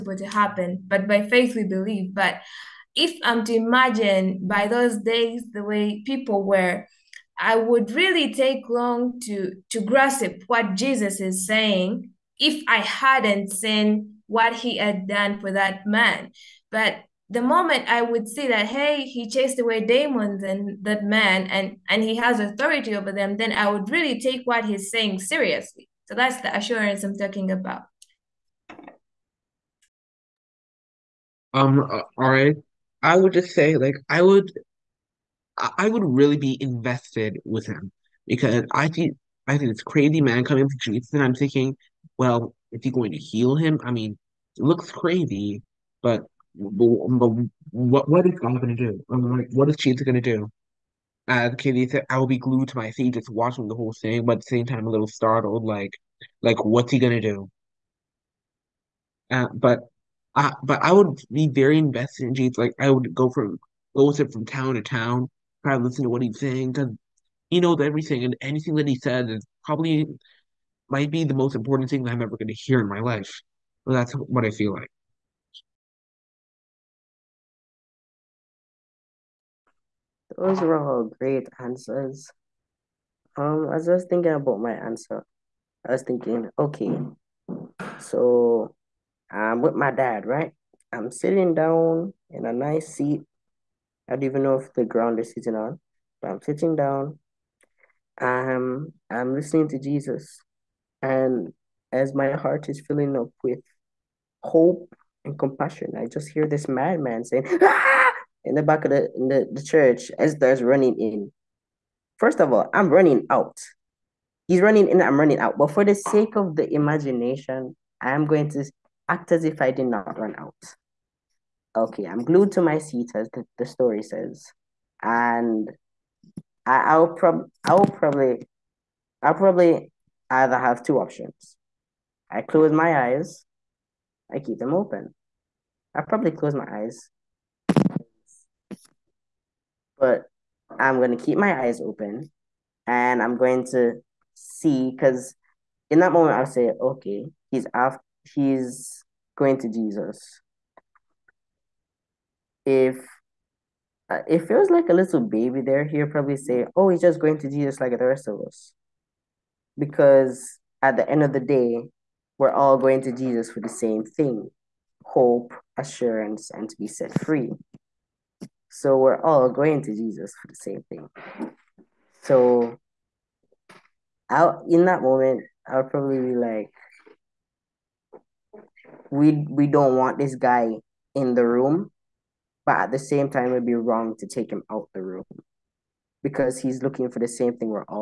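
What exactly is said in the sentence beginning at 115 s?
But for the sake of the imagination, I am going to act as if I did not run out.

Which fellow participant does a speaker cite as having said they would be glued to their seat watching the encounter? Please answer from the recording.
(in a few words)
Katie.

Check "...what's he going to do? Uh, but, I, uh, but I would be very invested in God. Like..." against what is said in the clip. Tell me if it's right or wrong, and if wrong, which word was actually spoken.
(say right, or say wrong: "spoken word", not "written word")
wrong: "Jesus", not "God".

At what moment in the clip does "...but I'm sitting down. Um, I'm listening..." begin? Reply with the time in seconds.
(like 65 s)
96 s.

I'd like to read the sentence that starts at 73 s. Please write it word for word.
Well, that's what I feel like.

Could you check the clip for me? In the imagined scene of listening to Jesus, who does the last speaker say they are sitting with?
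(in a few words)
My dad.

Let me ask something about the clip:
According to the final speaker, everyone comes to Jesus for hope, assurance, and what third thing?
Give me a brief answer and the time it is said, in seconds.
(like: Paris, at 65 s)
To be set free, at 166 s.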